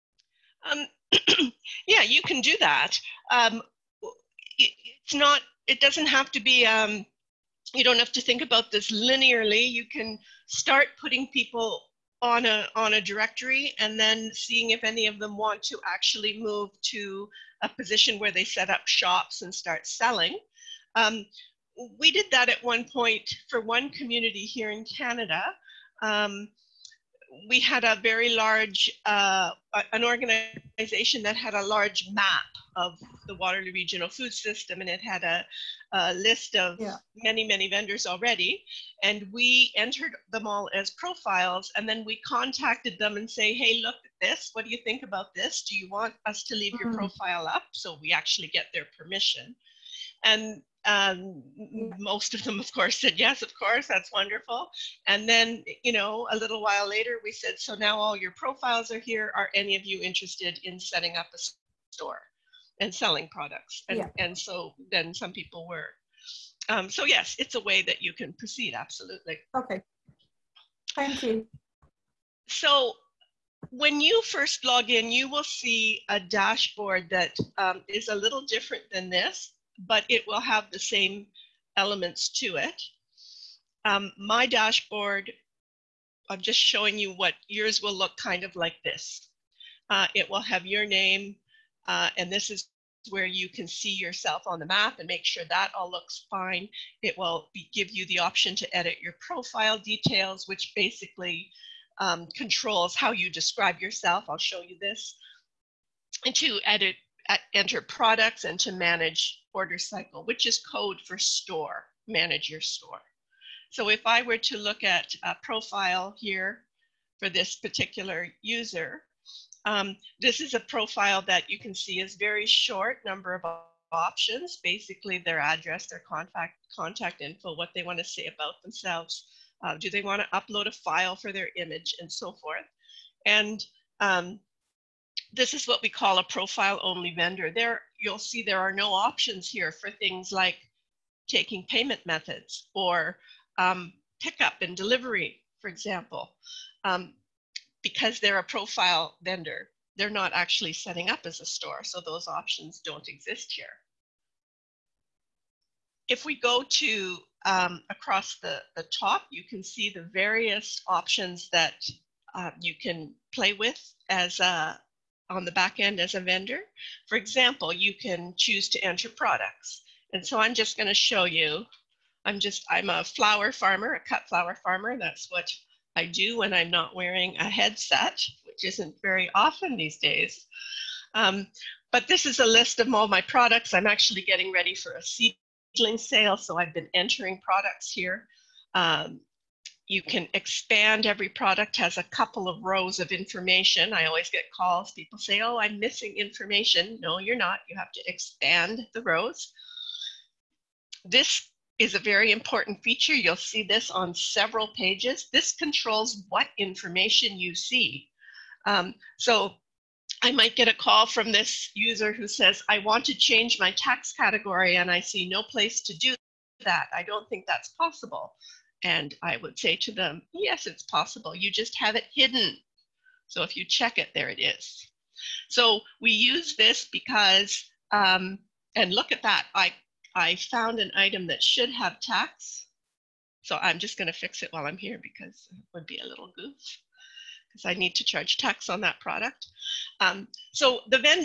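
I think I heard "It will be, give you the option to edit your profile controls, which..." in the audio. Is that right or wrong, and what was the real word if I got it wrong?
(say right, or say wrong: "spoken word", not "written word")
wrong: "details", not "controls".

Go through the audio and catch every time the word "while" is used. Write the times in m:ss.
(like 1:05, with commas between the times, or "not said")
0:56, 3:54.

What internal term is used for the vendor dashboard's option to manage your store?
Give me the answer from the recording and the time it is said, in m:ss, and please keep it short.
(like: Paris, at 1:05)
order cycle, at 1:49.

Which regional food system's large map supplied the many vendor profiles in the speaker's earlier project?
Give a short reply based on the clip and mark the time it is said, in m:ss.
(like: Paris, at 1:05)
Waterloo Regional Food System, at 0:33.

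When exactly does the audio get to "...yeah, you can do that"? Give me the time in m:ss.
0:01.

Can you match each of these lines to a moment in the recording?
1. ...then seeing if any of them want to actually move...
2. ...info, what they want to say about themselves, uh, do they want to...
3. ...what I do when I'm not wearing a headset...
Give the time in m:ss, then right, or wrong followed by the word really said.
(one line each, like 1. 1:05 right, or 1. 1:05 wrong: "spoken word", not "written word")
1. 0:13 right
2. 2:07 right
3. 2:55 right.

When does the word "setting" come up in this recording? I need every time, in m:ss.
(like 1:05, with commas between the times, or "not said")
1:00, 2:30.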